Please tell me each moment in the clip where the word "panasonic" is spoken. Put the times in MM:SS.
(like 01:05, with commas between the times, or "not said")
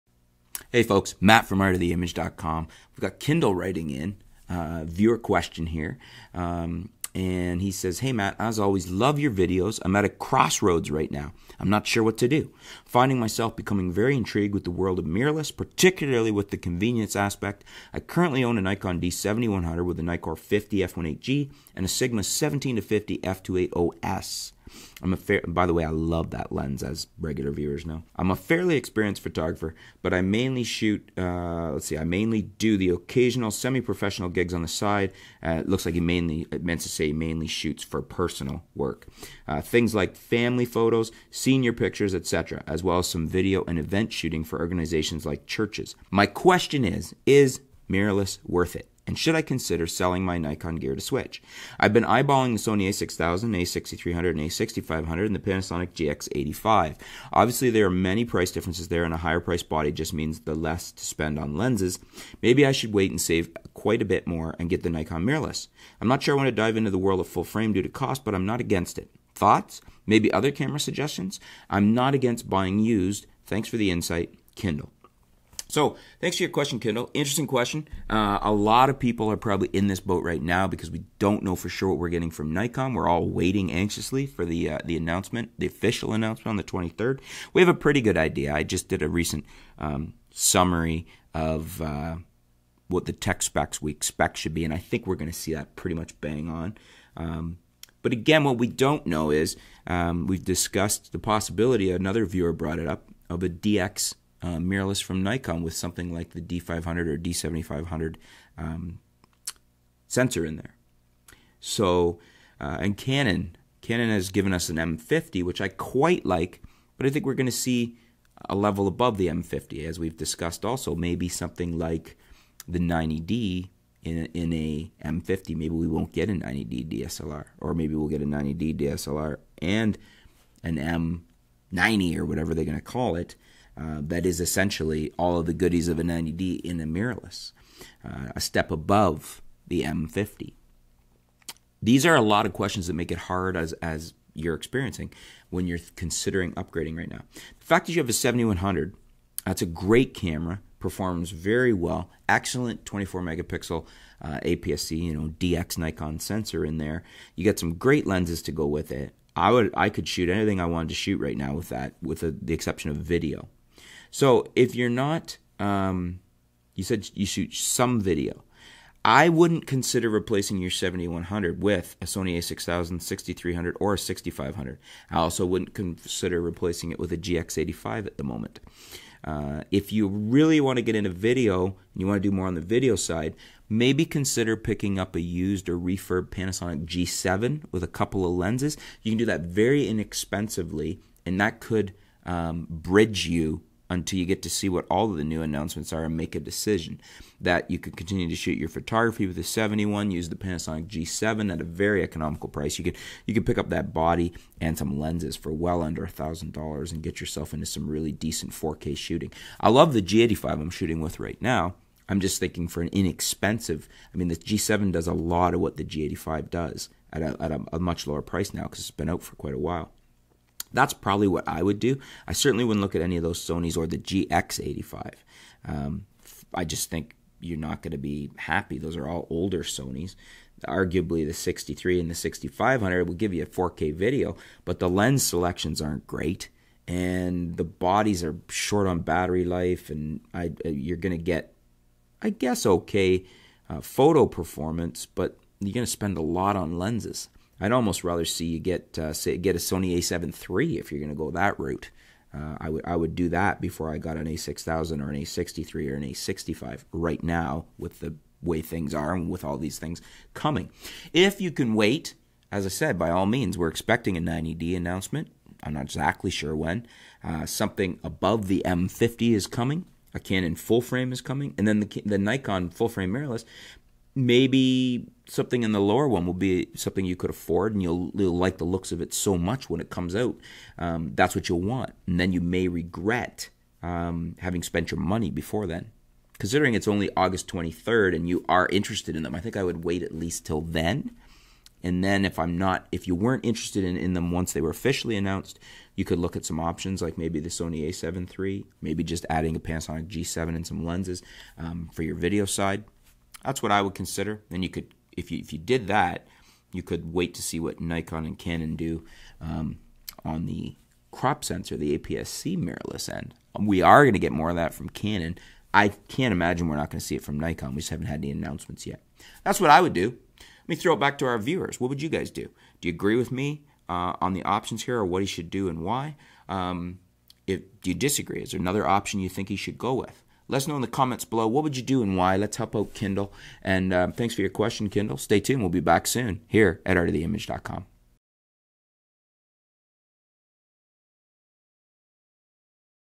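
00:55, 03:06, 03:20, 04:59.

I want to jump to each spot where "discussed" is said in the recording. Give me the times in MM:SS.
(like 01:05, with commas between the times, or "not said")
01:40, 02:00.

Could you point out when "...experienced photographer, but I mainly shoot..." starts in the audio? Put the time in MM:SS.
00:28.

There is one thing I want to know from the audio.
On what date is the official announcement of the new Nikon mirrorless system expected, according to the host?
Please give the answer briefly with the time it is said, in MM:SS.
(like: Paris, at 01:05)
the 23rd, at 01:26.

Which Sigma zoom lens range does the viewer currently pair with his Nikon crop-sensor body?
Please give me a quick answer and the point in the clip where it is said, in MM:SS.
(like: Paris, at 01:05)
17 to 50, at 00:22.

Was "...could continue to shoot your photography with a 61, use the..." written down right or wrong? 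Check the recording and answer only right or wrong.
wrong.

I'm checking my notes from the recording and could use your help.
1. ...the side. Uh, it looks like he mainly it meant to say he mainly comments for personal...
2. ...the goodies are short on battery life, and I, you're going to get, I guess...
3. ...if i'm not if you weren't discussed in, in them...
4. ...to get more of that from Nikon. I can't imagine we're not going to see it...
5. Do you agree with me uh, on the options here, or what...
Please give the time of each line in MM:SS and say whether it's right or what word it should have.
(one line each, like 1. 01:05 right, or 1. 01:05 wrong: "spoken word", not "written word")
1. 00:34 wrong: "shoots", not "comments"
2. 03:57 wrong: "bodies", not "goodies"
3. 04:52 wrong: "interested", not "discussed"
4. 05:14 wrong: "Canon", not "Nikon"
5. 05:22 right.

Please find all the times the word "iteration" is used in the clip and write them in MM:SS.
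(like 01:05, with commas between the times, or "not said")
not said.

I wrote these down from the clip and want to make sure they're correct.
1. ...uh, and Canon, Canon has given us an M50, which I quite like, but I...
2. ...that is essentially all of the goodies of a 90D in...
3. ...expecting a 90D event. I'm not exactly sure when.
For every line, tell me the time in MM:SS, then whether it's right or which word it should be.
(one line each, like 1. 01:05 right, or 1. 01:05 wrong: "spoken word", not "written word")
1. 01:52 right
2. 02:14 right
3. 04:23 wrong: "announcement", not "event".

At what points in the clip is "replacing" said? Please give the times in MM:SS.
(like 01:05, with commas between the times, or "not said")
02:50, 02:56.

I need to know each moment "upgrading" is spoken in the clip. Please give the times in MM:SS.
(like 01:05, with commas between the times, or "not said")
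02:26.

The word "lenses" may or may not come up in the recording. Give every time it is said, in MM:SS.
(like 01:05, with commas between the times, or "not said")
01:01, 02:38, 03:08, 03:24, 04:06, 05:00.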